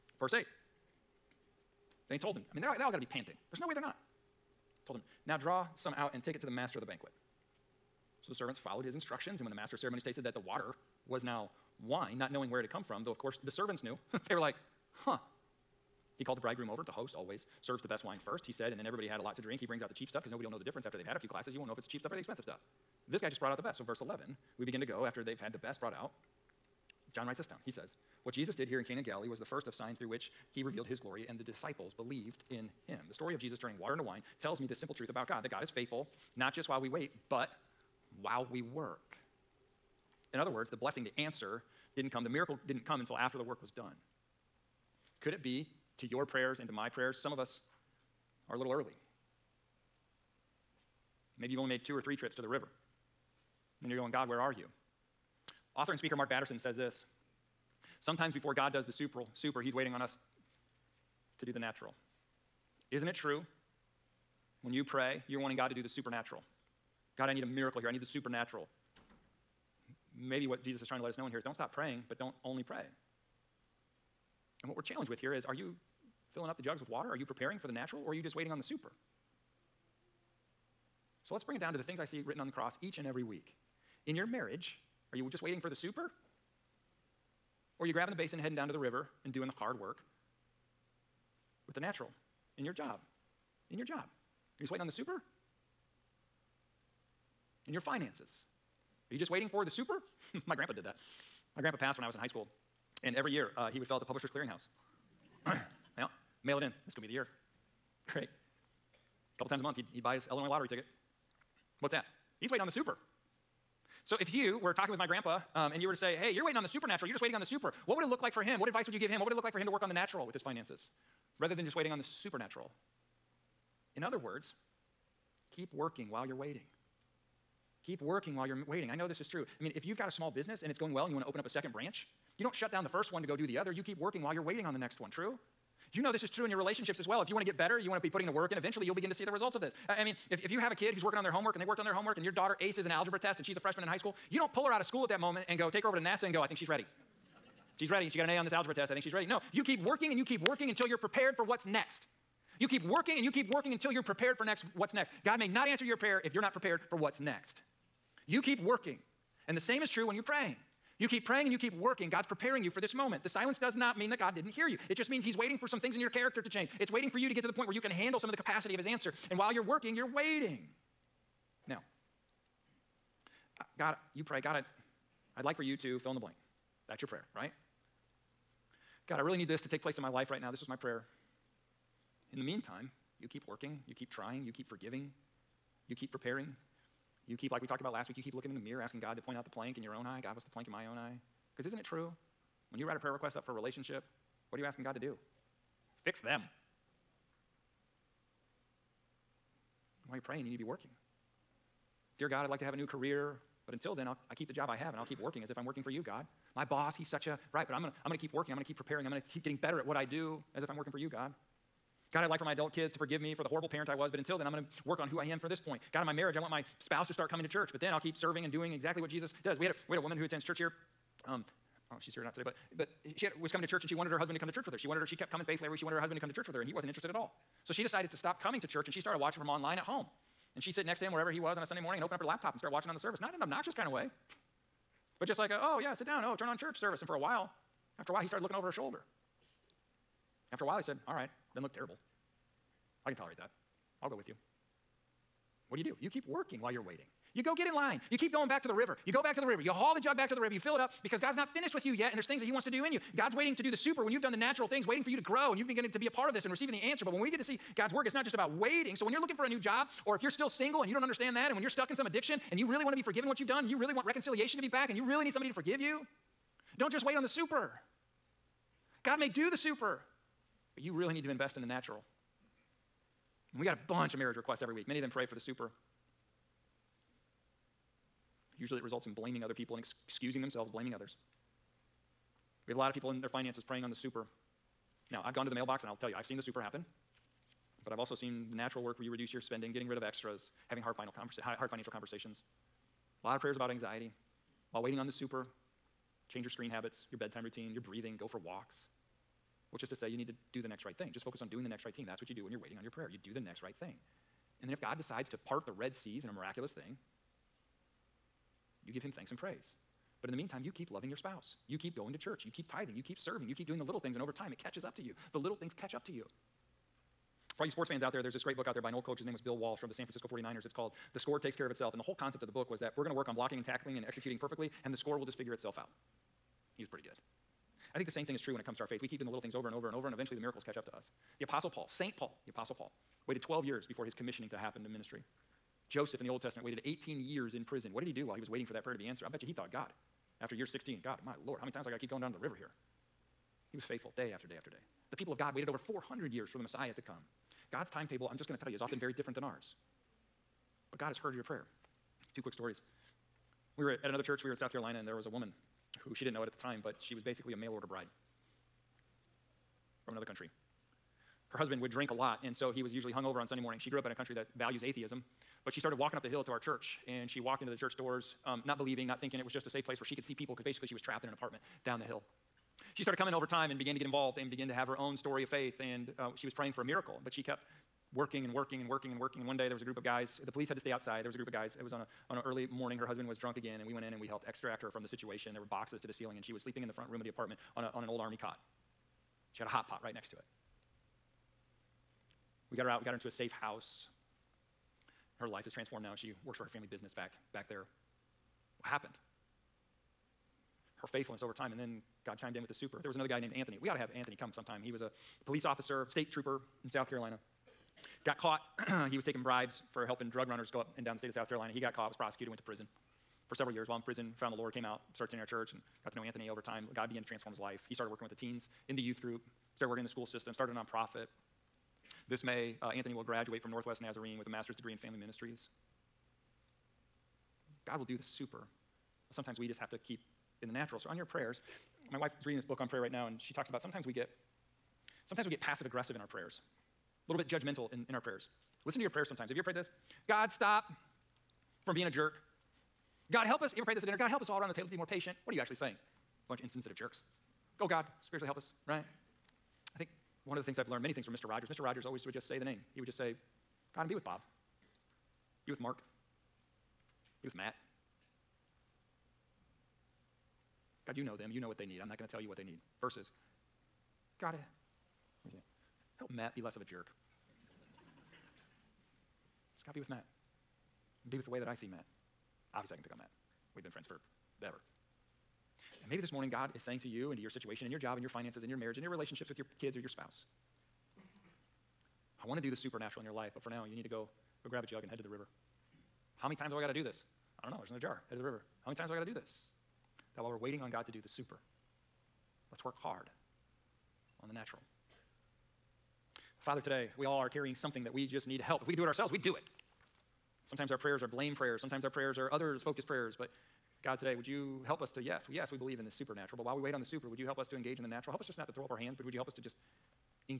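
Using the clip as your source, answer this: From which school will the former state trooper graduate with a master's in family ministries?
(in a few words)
Northwest Nazarene.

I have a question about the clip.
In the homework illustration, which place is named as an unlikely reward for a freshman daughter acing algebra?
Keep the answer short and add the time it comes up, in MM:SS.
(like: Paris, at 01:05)
NASA, at 02:25.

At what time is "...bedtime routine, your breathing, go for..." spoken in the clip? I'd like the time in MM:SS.
04:57.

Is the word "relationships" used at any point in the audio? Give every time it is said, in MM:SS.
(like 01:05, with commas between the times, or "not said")
02:16, 03:13, 07:59.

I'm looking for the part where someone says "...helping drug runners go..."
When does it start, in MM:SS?
06:50.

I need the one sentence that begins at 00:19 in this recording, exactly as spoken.
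He brings out the cheap stuff because nobody will know the difference after they've had a few glasses.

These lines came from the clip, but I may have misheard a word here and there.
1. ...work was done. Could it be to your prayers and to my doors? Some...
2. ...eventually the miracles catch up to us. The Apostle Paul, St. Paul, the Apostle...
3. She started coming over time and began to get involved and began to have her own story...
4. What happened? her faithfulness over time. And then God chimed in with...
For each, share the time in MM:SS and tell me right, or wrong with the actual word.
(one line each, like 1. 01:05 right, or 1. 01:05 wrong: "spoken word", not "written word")
1. 00:43 wrong: "prayers", not "doors"
2. 05:30 right
3. 06:12 right
4. 06:38 right.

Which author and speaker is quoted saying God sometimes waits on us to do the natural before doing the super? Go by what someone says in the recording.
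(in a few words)
Mark Batterson.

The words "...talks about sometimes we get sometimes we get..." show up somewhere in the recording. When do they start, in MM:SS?
07:13.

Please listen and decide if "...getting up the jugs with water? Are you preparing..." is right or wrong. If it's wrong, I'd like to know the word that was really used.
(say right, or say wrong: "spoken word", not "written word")
wrong: "filling", not "getting".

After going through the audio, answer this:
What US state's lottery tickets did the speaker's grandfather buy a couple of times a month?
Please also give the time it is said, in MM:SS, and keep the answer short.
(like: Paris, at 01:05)
Illinois, at 01:50.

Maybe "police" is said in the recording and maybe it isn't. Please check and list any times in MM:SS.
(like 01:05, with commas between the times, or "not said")
06:20, 06:45.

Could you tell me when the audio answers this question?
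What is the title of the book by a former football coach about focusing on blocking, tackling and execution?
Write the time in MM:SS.
05:21.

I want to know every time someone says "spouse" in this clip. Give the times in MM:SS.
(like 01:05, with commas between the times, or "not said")
03:36, 05:11, 08:00.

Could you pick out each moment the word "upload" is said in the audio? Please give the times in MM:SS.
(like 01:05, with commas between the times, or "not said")
not said.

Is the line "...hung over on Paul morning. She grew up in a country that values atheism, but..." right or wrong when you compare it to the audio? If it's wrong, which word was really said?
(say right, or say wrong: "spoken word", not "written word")
wrong: "Sunday", not "Paul".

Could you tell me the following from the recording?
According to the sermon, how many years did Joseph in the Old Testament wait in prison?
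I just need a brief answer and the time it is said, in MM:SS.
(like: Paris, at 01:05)
18, at 05:36.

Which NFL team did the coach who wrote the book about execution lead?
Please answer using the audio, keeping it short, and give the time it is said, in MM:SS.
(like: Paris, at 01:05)
San Francisco 49ers, at 05:19.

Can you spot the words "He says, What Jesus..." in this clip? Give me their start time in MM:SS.
00:27.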